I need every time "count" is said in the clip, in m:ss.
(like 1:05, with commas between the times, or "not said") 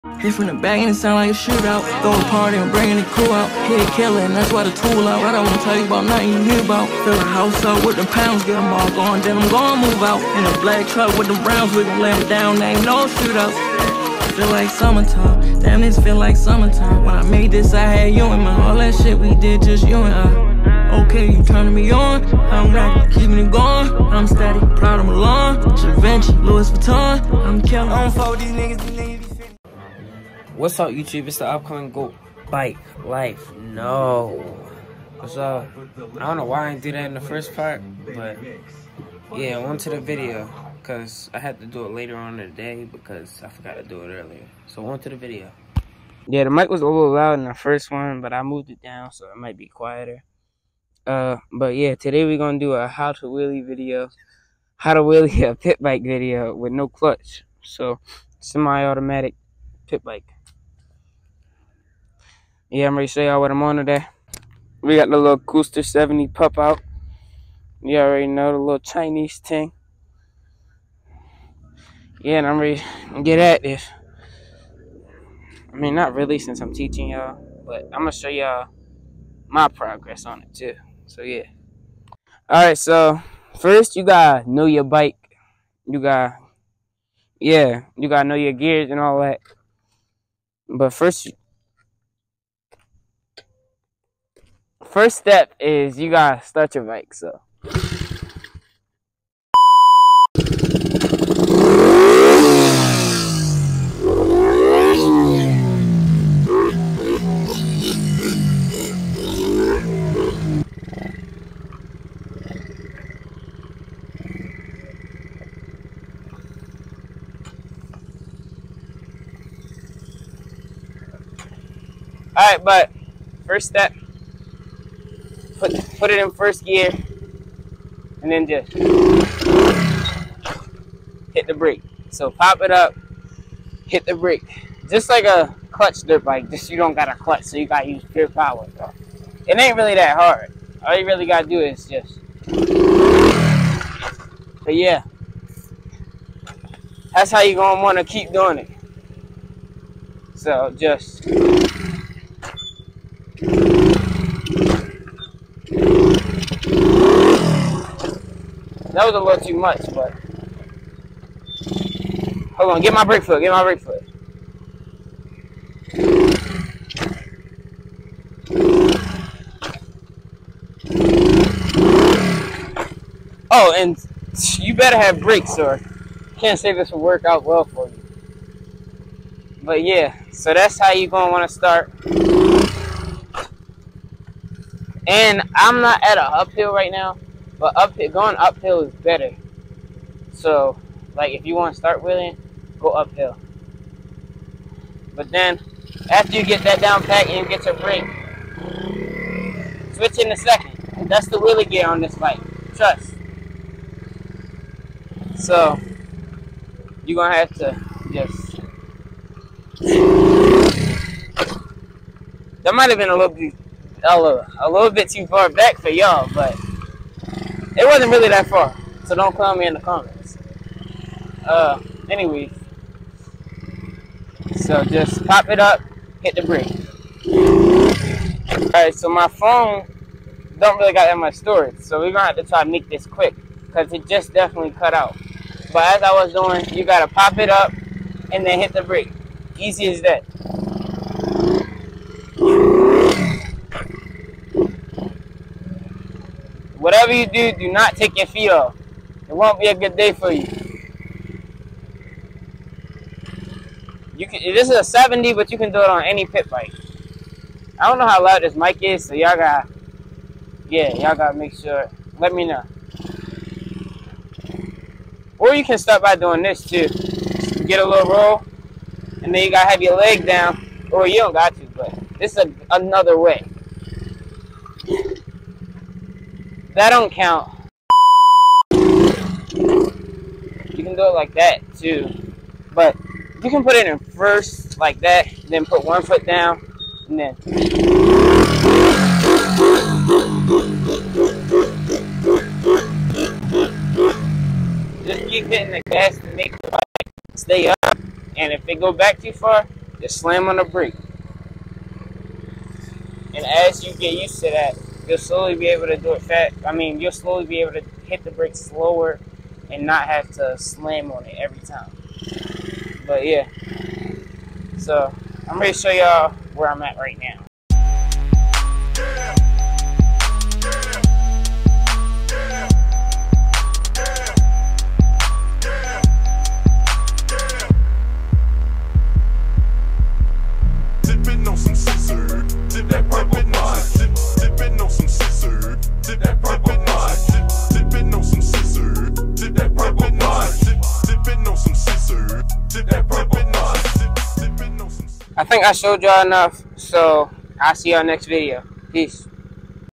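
4:37.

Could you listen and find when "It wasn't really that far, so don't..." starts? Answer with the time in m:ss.
3:37.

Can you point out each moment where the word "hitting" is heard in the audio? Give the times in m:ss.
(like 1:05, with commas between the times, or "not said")
4:55.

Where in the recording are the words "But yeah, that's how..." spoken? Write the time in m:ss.
2:24.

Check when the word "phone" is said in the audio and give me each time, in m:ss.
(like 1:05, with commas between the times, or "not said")
3:49.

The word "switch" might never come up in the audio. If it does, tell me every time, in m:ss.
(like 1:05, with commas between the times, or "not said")
3:19.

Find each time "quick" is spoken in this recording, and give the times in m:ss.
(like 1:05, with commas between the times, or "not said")
3:53.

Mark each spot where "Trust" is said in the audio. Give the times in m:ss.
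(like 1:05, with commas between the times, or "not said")
3:22.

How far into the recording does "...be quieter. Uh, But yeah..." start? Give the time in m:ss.
0:49.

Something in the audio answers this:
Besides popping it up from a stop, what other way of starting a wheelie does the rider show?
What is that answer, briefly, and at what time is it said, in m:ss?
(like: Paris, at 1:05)
a little roll, at 4:27.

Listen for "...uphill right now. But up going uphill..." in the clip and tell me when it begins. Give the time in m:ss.
3:06.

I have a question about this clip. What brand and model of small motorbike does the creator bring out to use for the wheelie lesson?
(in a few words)
Coolster 70.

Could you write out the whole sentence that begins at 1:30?
But first, First step is you gotta start your mic, so.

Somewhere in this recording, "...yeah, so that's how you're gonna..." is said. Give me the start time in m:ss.
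2:59.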